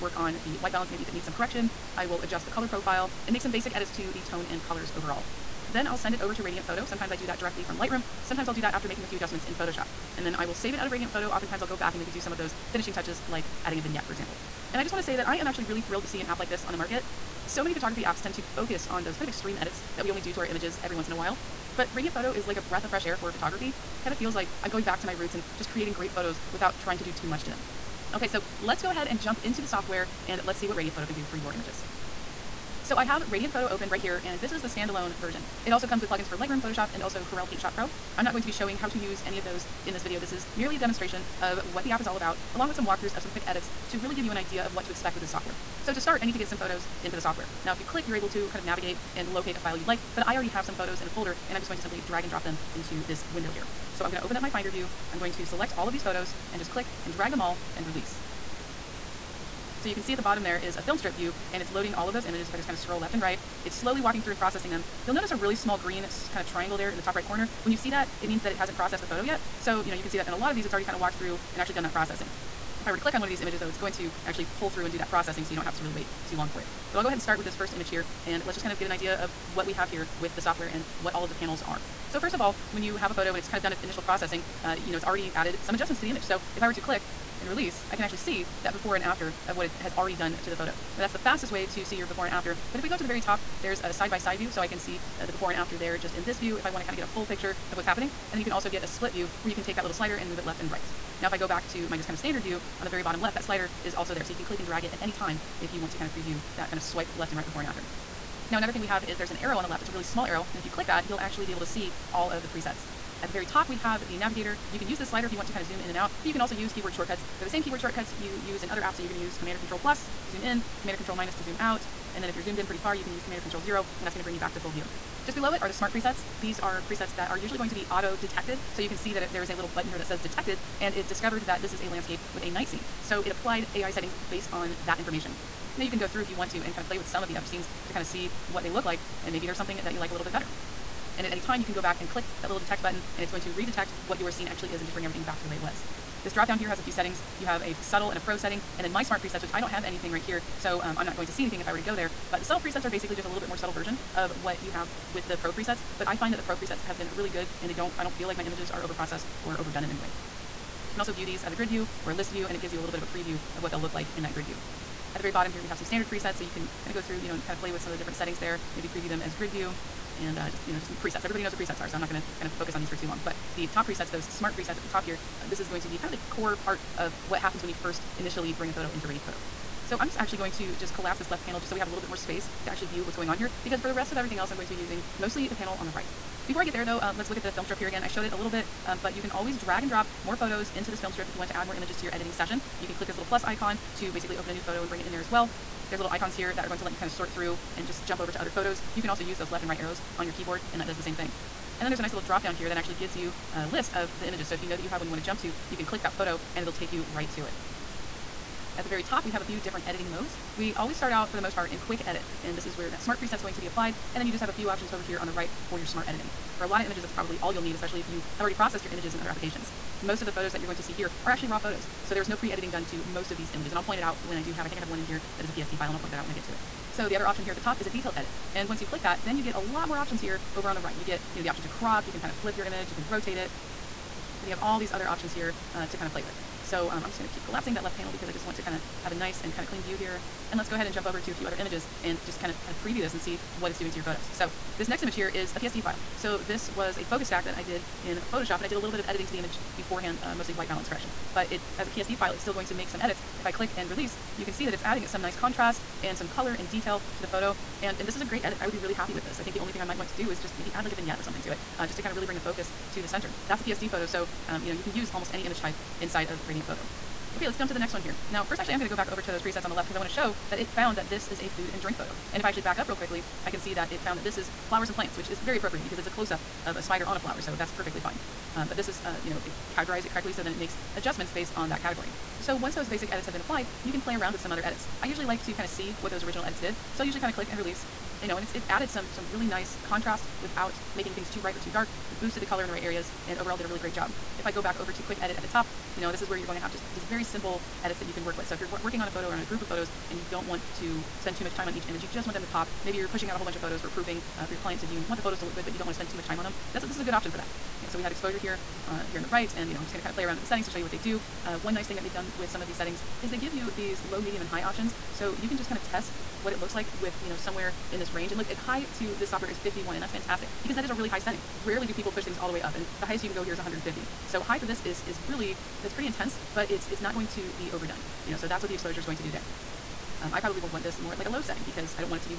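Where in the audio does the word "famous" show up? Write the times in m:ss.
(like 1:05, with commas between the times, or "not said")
not said.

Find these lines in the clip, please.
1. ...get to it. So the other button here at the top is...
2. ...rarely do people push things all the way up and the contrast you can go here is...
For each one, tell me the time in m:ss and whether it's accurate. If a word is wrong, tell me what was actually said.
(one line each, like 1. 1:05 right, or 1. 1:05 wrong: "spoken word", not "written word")
1. 3:46 wrong: "option", not "button"
2. 5:21 wrong: "highest", not "contrast".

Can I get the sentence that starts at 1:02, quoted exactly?
If I just kind of scroll left and right, it's slowly walking through and processing them.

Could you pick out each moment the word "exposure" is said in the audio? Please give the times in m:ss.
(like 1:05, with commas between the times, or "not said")
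5:08, 5:28.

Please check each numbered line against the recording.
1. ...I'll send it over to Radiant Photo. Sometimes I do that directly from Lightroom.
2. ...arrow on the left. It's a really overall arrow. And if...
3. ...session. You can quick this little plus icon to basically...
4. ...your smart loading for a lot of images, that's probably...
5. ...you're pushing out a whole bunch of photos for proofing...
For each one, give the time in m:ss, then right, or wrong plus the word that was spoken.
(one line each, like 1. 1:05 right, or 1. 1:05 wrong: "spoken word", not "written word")
1. 0:05 right
2. 1:49 wrong: "small", not "overall"
3. 3:12 wrong: "click", not "quick"
4. 3:35 wrong: "editing", not "loading"
5. 5:02 right.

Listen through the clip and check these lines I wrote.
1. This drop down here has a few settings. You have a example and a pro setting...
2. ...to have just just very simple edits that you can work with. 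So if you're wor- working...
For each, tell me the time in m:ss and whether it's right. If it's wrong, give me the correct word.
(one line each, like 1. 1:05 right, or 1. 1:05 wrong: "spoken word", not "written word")
1. 2:26 wrong: "subtle", not "example"
2. 4:56 right.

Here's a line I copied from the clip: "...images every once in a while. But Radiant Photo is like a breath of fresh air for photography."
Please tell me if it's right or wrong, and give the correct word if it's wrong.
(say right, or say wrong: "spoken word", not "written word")
right.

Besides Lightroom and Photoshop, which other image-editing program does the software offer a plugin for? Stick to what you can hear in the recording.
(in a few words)
Corel Paint Shop Pro.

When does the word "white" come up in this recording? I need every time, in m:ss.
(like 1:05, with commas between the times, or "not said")
0:00, 4:10.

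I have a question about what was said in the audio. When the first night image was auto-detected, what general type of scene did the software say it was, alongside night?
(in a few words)
landscape.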